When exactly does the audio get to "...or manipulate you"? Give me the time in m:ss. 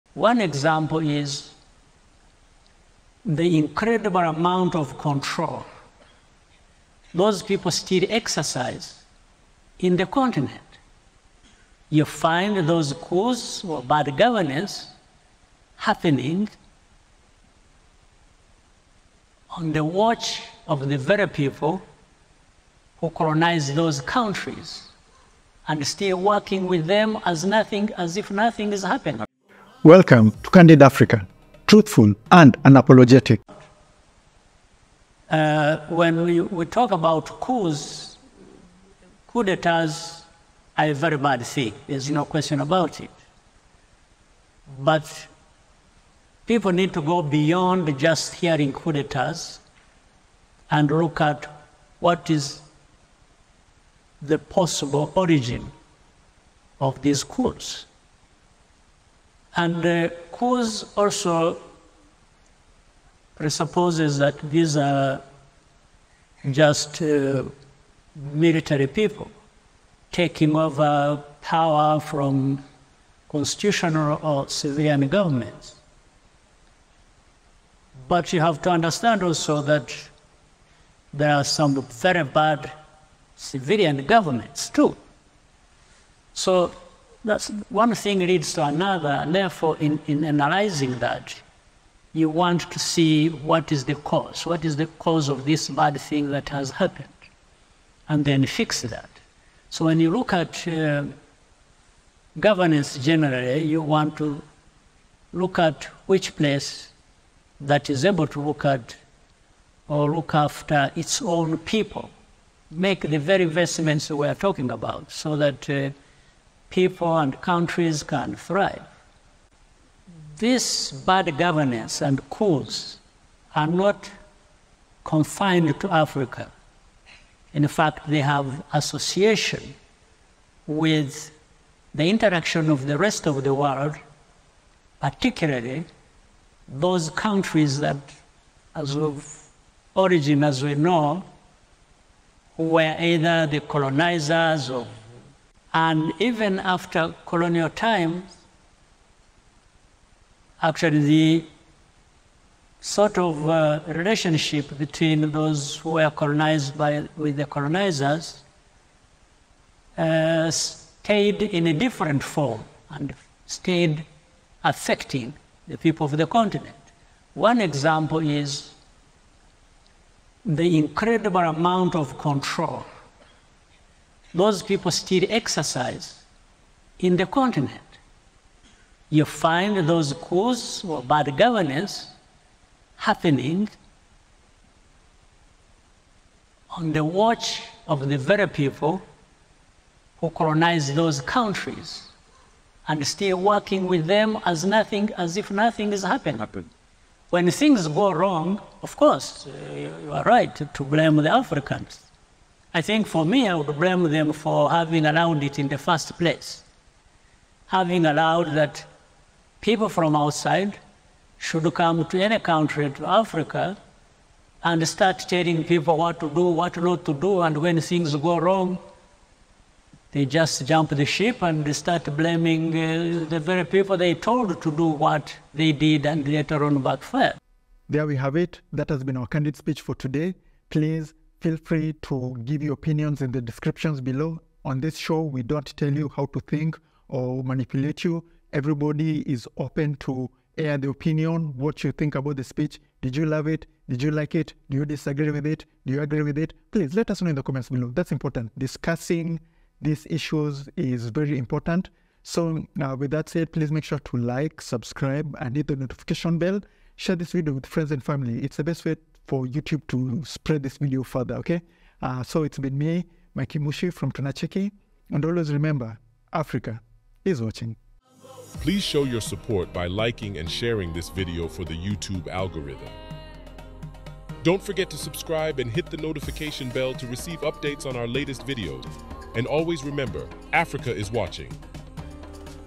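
3:57.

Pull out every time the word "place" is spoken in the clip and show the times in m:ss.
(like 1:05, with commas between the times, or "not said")
1:46, 3:26.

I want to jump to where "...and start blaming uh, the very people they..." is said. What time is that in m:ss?
3:41.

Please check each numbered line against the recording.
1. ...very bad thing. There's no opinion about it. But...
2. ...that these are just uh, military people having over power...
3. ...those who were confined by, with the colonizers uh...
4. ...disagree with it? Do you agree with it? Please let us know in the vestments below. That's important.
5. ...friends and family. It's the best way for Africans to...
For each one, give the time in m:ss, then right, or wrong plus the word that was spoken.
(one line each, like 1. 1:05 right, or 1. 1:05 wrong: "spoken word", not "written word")
1. 0:40 wrong: "question", not "opinion"
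2. 1:04 wrong: "taking", not "having"
3. 2:35 wrong: "colonized", not "confined"
4. 4:04 wrong: "comments", not "vestments"
5. 4:17 wrong: "YouTube", not "Africans".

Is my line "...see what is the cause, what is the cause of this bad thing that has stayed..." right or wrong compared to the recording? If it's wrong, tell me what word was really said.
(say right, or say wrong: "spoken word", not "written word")
wrong: "happened", not "stayed".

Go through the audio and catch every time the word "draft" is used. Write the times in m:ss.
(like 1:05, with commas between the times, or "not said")
not said.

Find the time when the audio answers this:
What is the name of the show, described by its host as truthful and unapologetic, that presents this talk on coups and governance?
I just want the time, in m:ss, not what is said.
0:30.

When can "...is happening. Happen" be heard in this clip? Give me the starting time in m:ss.
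3:15.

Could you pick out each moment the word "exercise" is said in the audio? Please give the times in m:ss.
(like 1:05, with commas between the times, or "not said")
0:08, 2:55.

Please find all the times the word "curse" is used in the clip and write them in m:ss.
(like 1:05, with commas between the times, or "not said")
not said.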